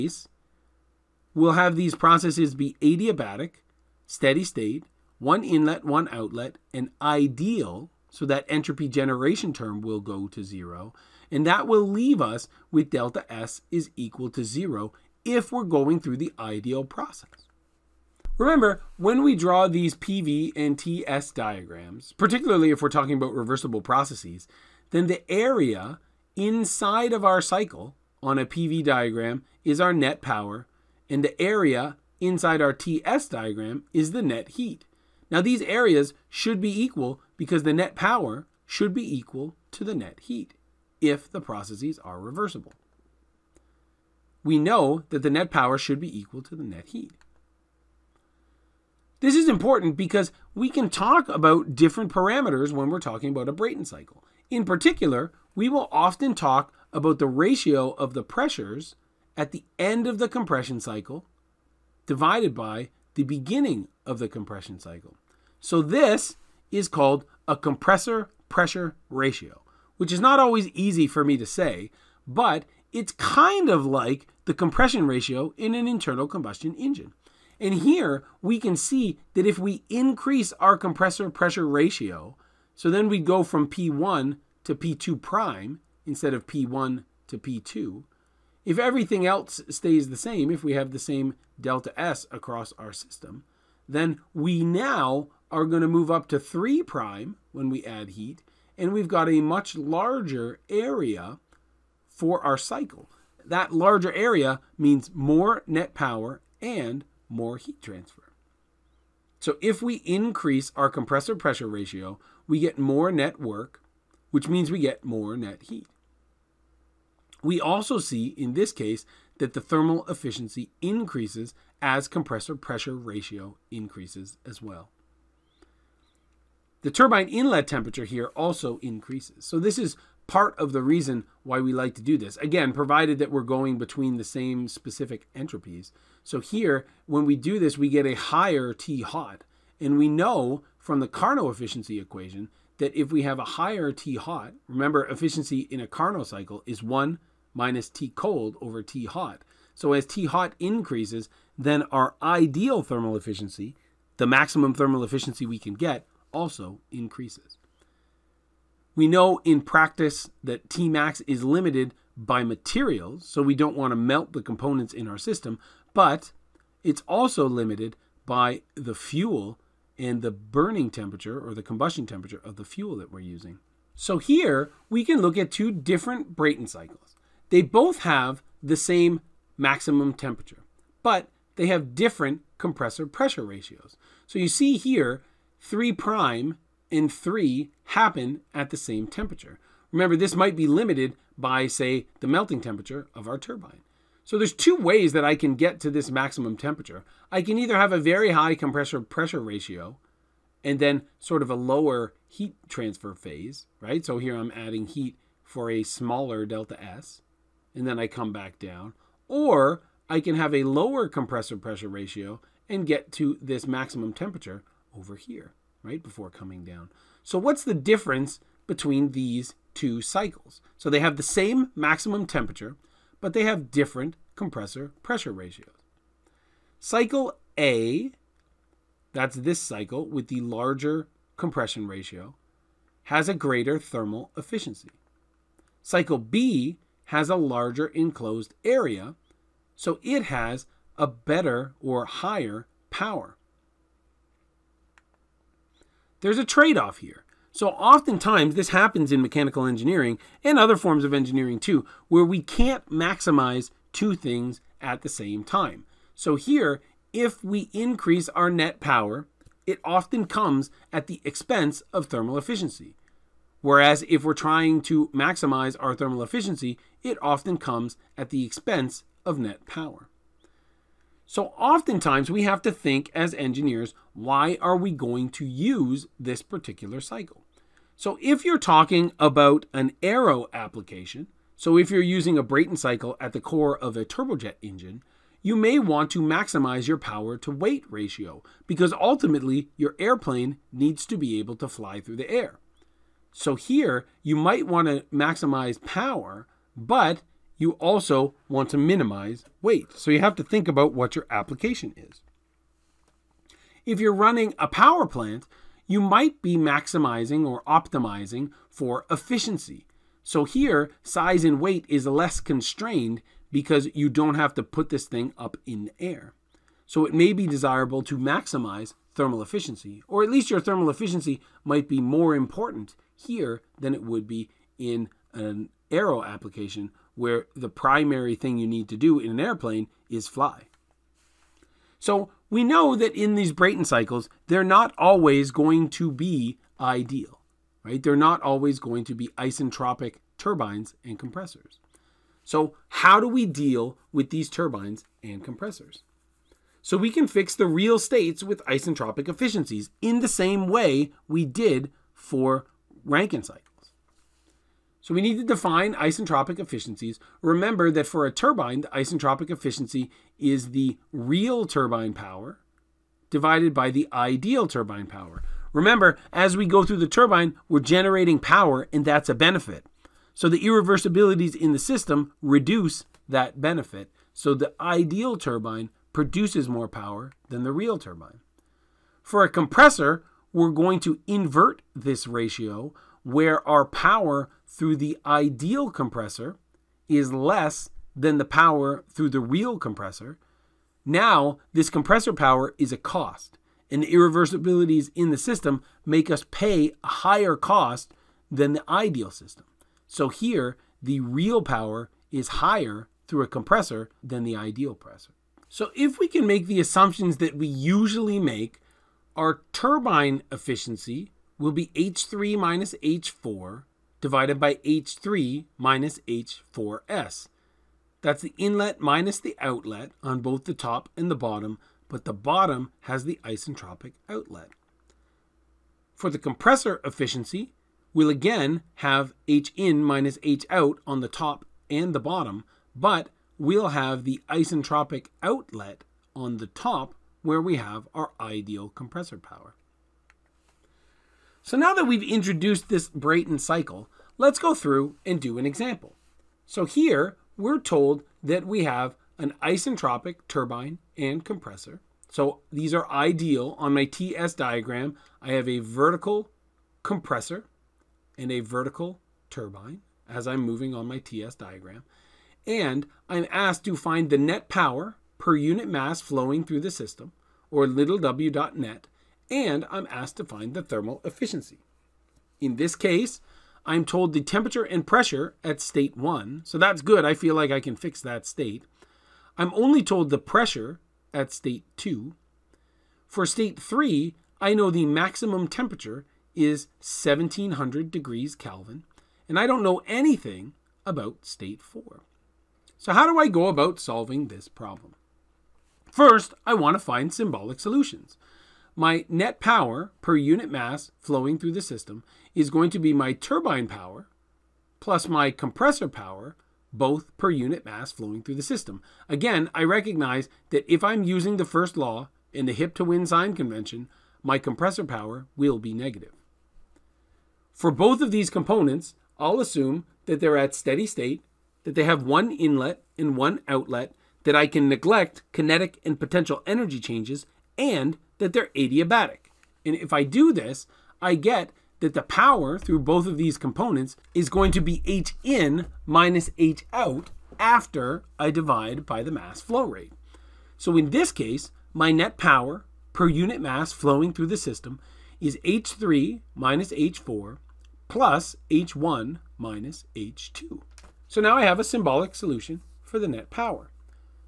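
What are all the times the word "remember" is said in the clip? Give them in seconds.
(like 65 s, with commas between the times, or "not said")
18 s, 144 s, 189 s, 357 s, 365 s.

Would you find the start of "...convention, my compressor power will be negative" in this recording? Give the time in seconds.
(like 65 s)
513 s.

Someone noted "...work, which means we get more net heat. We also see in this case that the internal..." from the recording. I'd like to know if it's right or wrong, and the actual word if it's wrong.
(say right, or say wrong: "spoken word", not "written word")
wrong: "thermal", not "internal".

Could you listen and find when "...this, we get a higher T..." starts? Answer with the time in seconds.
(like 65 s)
137 s.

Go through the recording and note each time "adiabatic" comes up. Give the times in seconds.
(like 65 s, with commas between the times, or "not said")
2 s, 528 s.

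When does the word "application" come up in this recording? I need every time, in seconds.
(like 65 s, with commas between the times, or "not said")
280 s, 301 s, 326 s.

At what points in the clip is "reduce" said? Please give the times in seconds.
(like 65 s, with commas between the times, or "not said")
372 s.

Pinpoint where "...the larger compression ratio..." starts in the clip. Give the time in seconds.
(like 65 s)
230 s.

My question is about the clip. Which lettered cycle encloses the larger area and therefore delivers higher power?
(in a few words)
Cycle B.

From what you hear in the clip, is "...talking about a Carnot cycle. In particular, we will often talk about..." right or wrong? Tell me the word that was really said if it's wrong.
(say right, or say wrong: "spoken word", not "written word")
wrong: "Brayton", not "Carnot".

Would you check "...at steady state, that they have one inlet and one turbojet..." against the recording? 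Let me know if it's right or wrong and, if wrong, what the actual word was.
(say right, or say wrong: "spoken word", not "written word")
wrong: "outlet", not "turbojet".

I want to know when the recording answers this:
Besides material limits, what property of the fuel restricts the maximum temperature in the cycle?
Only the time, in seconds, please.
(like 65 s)
171 s.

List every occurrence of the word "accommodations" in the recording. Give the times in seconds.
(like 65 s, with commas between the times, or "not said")
not said.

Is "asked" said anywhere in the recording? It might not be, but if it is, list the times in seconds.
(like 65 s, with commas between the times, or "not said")
463 s, 470 s.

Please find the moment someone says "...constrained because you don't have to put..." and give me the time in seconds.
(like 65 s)
312 s.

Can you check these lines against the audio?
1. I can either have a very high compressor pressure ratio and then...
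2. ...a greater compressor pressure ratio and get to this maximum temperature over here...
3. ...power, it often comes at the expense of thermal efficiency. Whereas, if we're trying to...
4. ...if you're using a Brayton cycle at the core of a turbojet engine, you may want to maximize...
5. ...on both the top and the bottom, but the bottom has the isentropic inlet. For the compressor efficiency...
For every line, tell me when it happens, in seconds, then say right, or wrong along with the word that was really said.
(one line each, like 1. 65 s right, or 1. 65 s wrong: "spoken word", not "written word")
1. 197 s right
2. 210 s wrong: "lower", not "greater"
3. 258 s right
4. 281 s right
5. 420 s wrong: "outlet", not "inlet".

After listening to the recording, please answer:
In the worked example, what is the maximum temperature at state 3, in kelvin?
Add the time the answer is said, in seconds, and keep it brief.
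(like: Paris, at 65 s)
1700, at 486 s.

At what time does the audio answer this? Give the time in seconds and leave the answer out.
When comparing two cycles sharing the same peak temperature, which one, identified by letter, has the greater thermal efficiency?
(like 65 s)
226 s.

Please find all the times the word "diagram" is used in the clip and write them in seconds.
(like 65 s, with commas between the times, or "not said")
21 s, 28 s, 33 s, 454 s, 461 s.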